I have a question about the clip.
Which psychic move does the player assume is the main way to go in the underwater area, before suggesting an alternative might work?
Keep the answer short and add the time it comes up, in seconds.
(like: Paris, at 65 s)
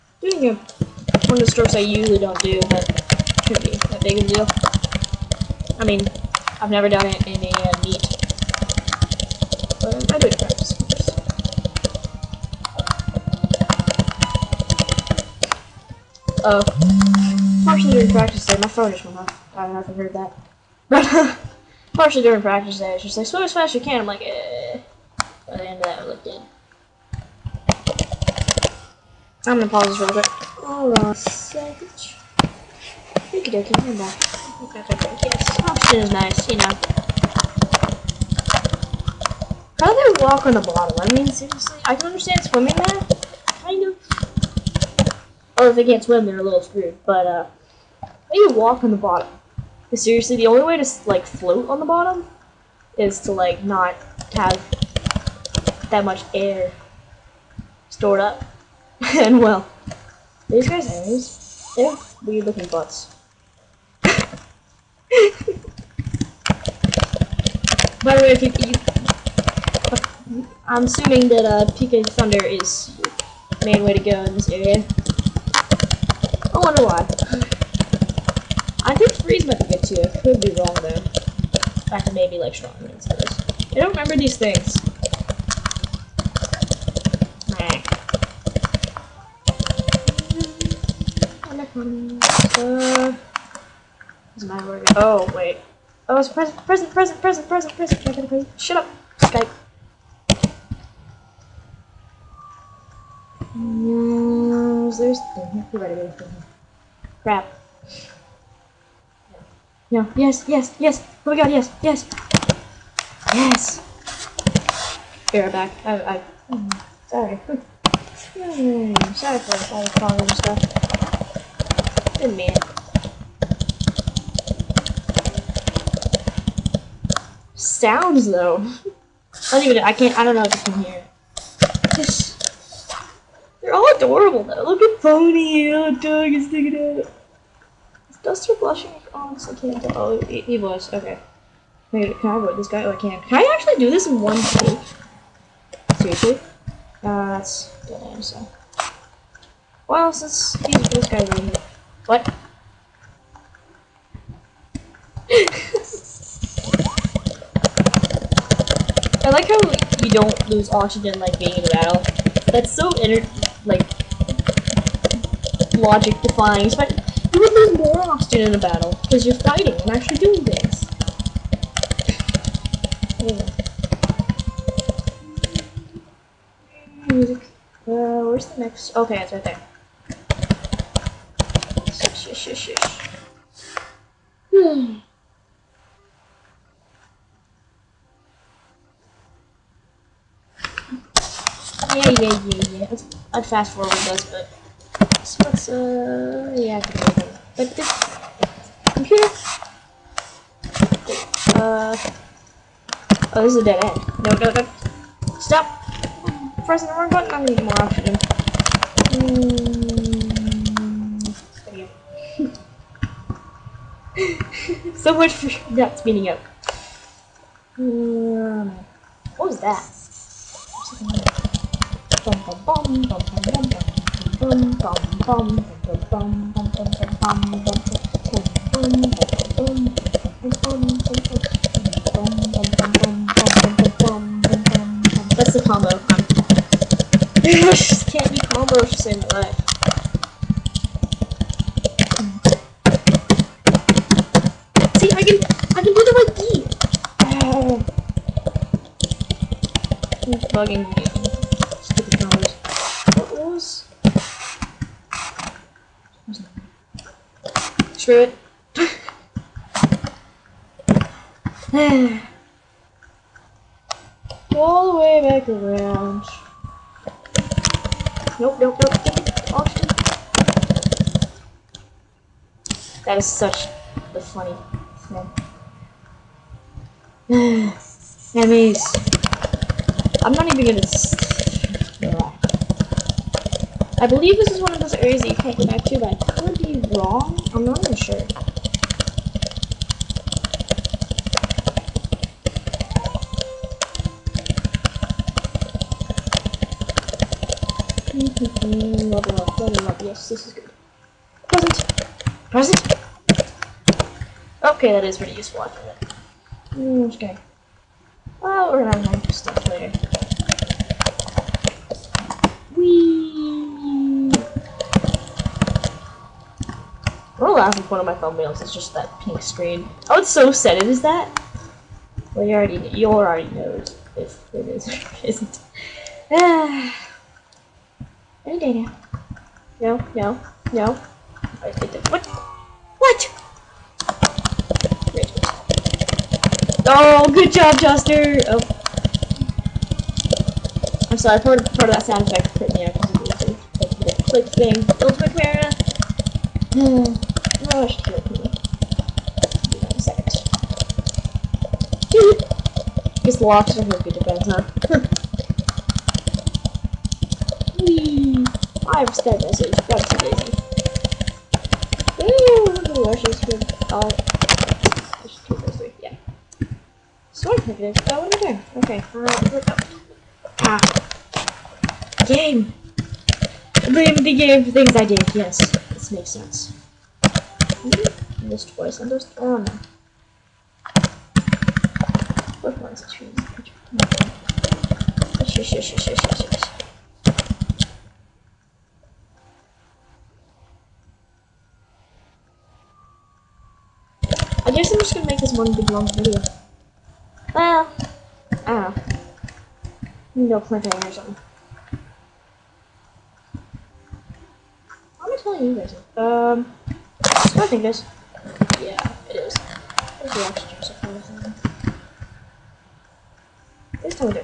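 PK Thunder, at 71 s.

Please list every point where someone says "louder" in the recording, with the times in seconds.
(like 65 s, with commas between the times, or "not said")
not said.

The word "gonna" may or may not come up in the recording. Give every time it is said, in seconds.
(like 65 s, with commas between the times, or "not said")
29 s, 280 s, 308 s, 395 s.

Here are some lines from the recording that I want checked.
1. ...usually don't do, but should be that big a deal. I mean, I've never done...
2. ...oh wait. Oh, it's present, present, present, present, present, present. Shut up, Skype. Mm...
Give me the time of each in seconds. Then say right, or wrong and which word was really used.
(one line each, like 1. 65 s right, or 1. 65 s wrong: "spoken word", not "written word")
1. 1 s right
2. 94 s right.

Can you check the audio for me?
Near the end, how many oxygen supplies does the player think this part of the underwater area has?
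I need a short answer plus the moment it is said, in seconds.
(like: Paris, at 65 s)
2, at 410 s.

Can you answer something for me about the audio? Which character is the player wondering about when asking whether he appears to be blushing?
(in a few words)
Duster.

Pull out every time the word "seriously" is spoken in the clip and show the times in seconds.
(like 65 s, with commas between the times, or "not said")
41 s, 49 s, 145 s.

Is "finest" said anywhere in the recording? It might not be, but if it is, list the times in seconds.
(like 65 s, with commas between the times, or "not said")
not said.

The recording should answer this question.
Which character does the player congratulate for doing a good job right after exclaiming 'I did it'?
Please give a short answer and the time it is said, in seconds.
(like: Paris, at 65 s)
Chester, at 337 s.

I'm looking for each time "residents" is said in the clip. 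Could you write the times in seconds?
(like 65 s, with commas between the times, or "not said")
not said.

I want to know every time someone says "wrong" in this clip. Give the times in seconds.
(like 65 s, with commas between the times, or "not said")
80 s, 206 s, 286 s.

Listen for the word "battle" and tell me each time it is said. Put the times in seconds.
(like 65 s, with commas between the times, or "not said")
161 s, 168 s.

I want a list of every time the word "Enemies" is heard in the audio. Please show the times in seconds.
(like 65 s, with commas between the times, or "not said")
278 s.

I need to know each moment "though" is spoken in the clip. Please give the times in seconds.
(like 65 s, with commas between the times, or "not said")
80 s, 128 s, 134 s.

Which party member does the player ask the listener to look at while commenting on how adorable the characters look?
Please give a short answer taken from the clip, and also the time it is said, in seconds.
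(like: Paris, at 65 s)
Boney, at 135 s.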